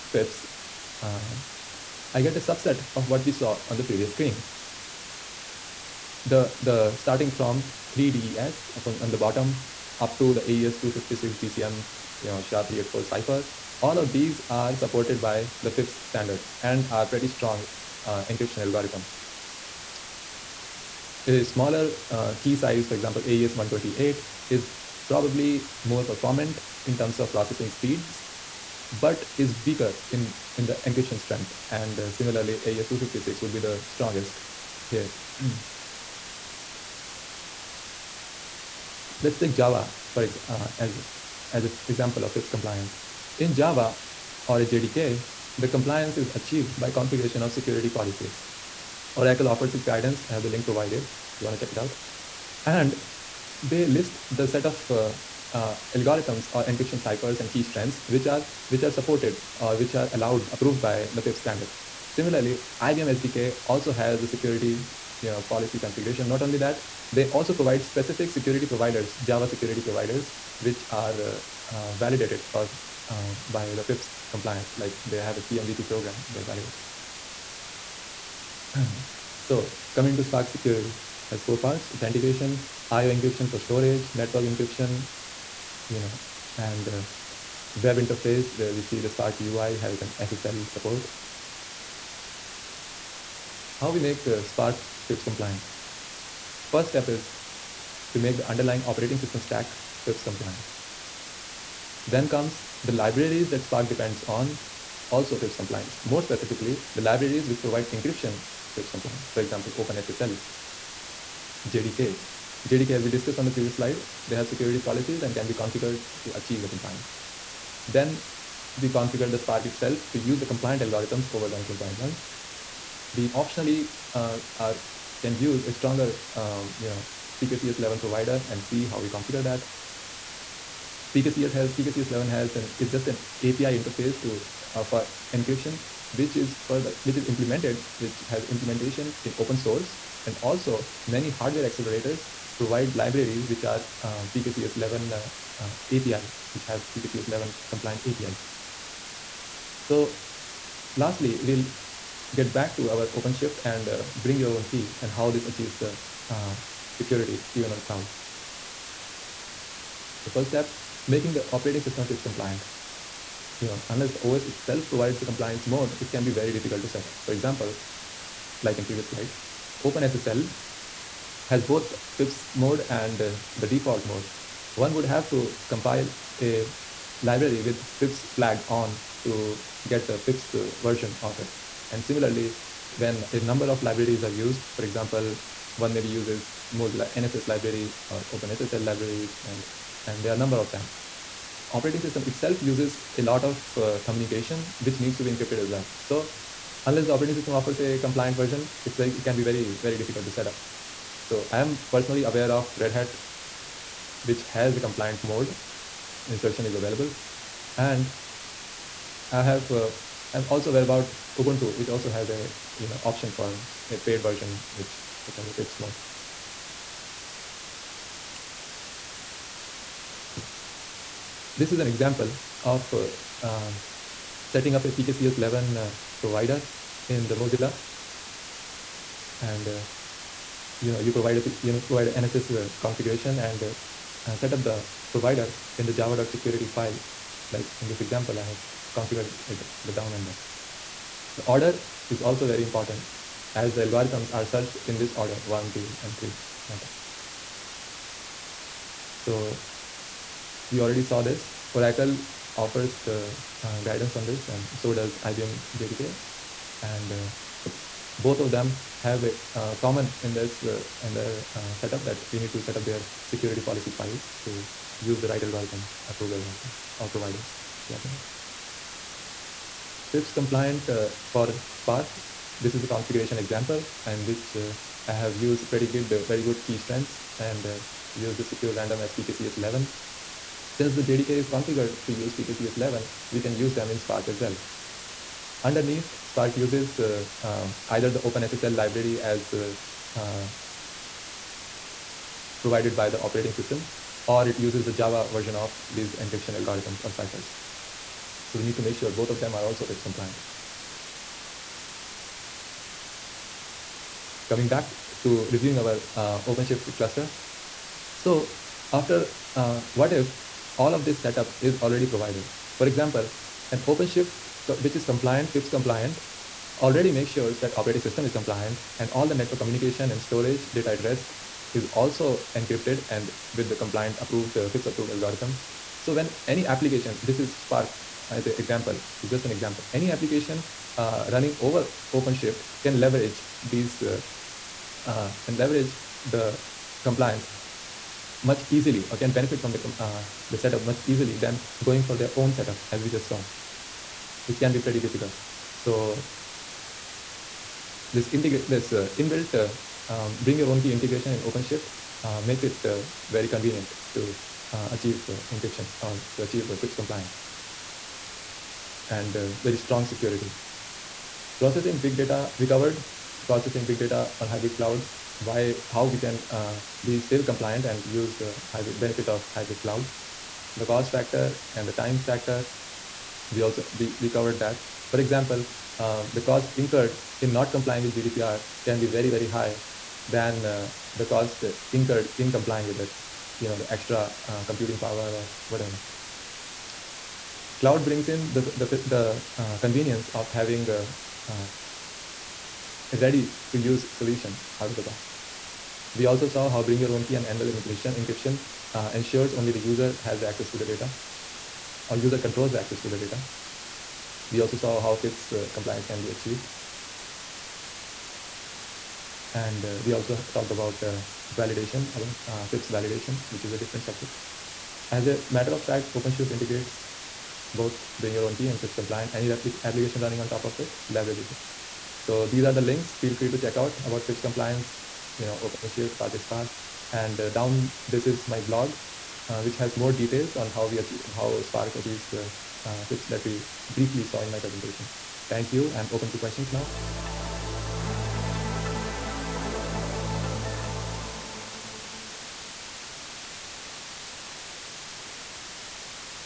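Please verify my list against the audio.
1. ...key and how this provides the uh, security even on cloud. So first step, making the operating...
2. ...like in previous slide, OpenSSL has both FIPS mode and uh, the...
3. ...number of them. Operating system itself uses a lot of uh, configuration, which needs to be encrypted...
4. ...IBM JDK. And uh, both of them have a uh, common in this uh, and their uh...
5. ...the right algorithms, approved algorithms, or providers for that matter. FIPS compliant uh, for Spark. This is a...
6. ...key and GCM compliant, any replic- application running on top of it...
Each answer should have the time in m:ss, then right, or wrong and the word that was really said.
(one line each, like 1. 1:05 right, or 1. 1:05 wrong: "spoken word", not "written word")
1. 2:34 wrong: "achieves", not "provides"
2. 2:48 right
3. 3:10 wrong: "communication", not "configuration"
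4. 4:15 right
5. 4:25 right
6. 6:58 wrong: "FIPS", not "GCM".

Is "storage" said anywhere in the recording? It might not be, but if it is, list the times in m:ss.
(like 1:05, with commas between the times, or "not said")
1:23, 5:20.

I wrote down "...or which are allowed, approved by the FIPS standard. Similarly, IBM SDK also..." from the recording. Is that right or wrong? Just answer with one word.
right.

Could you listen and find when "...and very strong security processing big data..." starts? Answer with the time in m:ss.
5:59.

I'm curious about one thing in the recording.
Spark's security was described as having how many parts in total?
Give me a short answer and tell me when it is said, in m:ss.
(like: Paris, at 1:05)
4, at 1:21.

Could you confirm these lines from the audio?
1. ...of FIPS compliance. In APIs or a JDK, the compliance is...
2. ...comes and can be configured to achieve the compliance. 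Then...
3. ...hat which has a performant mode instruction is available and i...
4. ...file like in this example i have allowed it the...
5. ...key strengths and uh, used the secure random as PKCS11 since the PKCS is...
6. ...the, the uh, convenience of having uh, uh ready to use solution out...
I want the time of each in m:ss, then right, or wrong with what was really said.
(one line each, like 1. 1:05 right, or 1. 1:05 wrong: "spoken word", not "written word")
1. 0:42 wrong: "Java", not "APIs"
2. 1:54 wrong: "policies", not "comes"
3. 3:22 wrong: "compliant", not "performant"
4. 3:56 wrong: "configured", not "allowed"
5. 4:36 wrong: "JDK", not "PKCS"
6. 6:28 right.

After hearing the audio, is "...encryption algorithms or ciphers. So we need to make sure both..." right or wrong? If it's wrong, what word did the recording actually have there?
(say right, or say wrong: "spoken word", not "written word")
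right.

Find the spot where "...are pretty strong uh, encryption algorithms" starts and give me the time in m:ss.
0:16.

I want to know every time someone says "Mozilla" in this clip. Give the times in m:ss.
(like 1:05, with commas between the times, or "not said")
3:06, 3:47.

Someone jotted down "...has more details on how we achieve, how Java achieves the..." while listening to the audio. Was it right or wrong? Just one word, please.
wrong.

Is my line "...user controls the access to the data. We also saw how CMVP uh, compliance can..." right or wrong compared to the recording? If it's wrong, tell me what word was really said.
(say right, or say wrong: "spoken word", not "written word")
wrong: "FIPS", not "CMVP".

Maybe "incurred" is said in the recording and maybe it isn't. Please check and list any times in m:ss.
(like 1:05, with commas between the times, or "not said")
6:16, 6:21.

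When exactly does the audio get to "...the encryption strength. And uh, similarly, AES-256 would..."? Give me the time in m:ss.
0:30.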